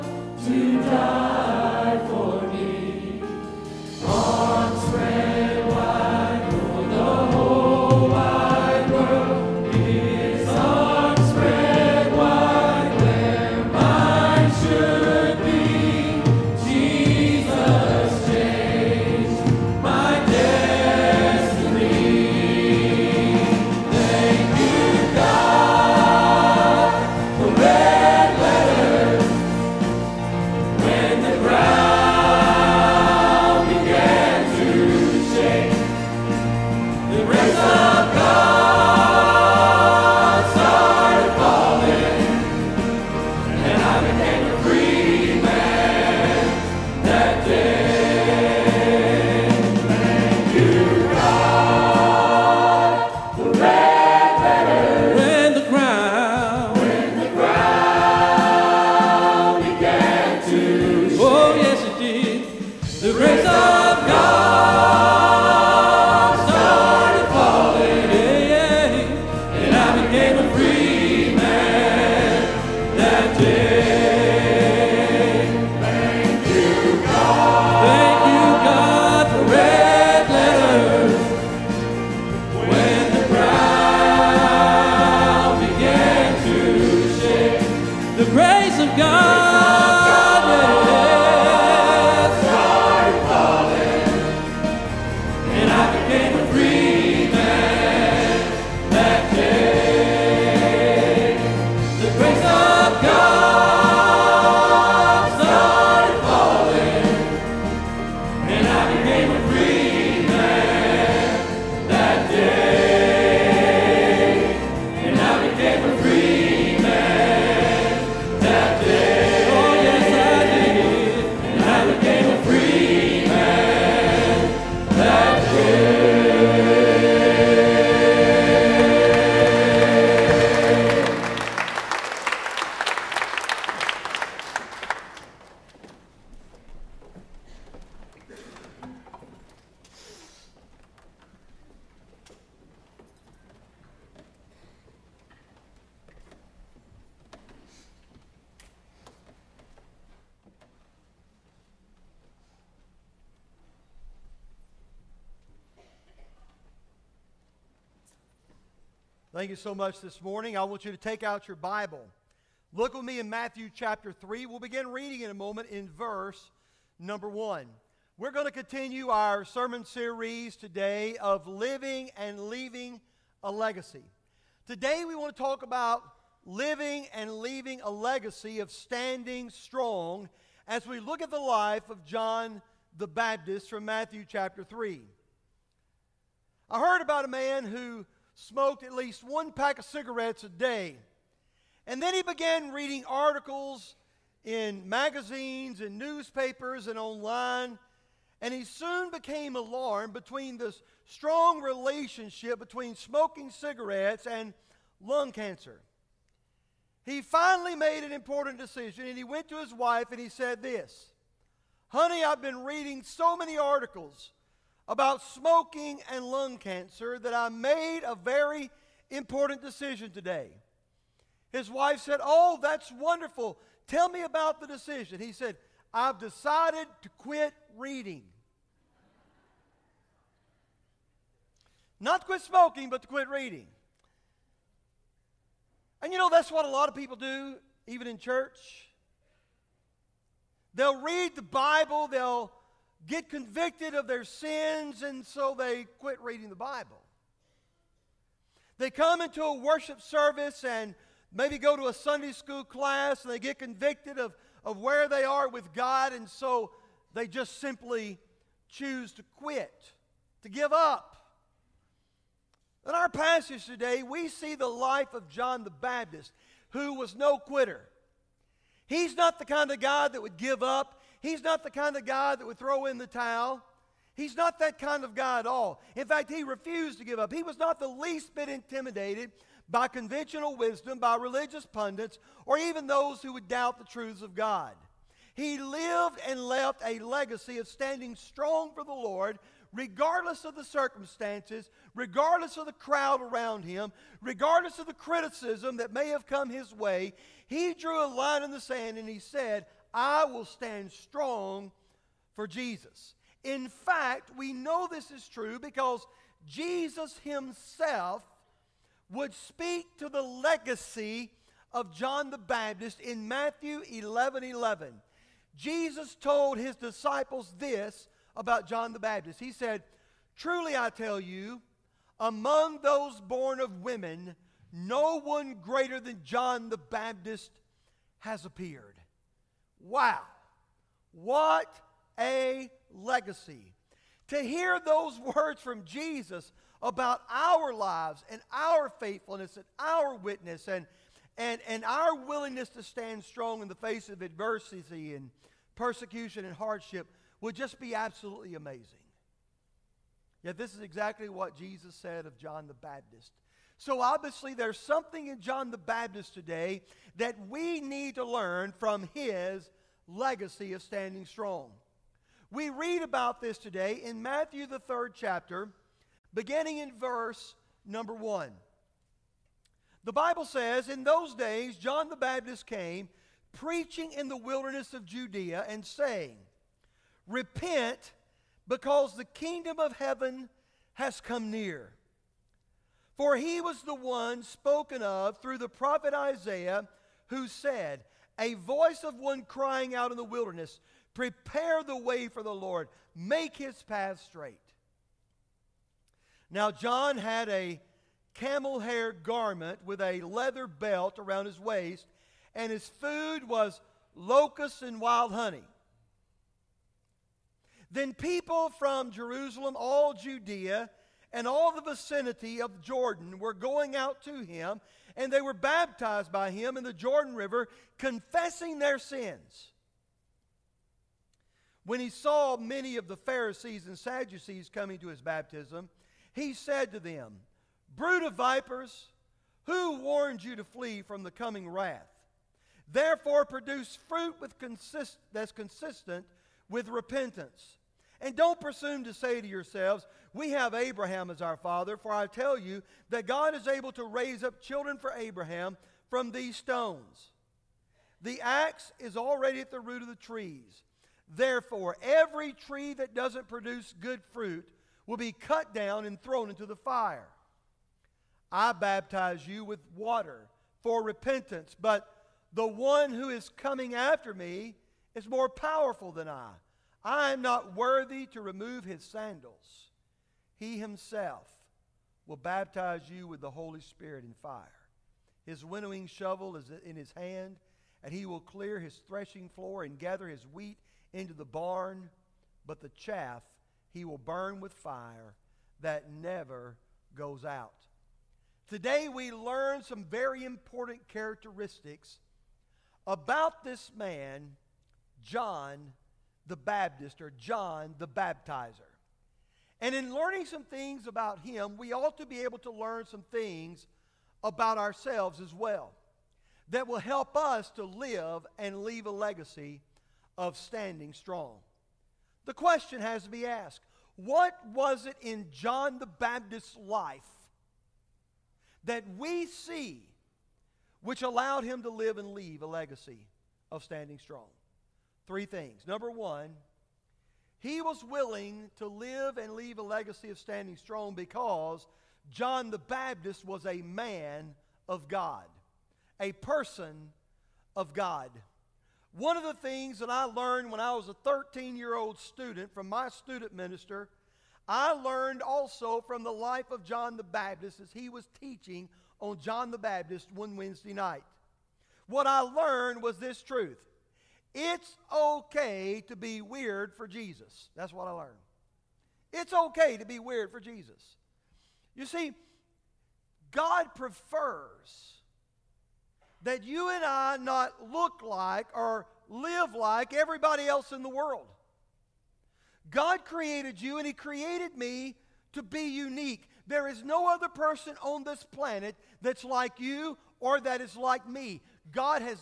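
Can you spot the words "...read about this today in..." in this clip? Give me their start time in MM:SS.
06:02.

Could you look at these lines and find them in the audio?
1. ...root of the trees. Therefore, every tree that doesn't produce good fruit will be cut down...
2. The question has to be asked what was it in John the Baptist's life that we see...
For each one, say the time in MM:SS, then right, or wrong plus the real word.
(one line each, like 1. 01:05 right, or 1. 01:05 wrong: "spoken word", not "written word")
1. 07:29 right
2. 08:32 right.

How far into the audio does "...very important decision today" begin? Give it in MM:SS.
03:38.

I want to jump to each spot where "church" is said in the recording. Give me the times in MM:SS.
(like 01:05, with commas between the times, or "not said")
03:58.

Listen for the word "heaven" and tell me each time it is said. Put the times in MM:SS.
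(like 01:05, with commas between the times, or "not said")
06:19.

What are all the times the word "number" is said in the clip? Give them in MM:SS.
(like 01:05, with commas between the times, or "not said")
02:46, 06:07, 08:45.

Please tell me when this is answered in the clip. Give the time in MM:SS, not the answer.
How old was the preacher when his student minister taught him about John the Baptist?
09:01.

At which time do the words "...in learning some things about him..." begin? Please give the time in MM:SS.
08:19.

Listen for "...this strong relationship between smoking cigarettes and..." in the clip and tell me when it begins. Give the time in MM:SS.
03:20.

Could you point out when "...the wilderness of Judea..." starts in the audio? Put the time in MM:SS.
06:14.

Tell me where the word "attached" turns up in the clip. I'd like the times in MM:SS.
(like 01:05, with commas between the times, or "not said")
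not said.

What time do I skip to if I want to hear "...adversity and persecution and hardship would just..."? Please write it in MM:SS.
05:44.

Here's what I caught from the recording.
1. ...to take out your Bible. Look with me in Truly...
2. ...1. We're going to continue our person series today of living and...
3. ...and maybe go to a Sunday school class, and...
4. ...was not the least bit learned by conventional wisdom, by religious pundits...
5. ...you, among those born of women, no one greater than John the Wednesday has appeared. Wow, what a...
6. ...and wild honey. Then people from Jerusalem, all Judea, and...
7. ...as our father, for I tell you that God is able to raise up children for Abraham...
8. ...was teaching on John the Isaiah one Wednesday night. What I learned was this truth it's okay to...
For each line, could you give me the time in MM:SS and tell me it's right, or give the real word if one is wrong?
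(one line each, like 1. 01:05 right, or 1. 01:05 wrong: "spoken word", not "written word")
1. 02:40 wrong: "Matthew", not "Truly"
2. 02:47 wrong: "sermon", not "person"
3. 04:10 right
4. 04:37 wrong: "intimidated", not "learned"
5. 05:21 wrong: "Baptist", not "Wednesday"
6. 06:44 right
7. 07:21 right
8. 09:08 wrong: "Baptist", not "Isaiah".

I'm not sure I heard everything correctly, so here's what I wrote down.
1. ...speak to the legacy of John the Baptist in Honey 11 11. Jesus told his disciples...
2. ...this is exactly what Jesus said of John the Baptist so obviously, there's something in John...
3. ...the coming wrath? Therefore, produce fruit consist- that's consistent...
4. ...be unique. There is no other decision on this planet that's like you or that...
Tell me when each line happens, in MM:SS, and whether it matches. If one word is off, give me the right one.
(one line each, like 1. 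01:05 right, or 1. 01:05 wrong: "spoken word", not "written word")
1. 05:09 wrong: "Matthew", not "Honey"
2. 05:50 right
3. 07:11 right
4. 09:35 wrong: "person", not "decision".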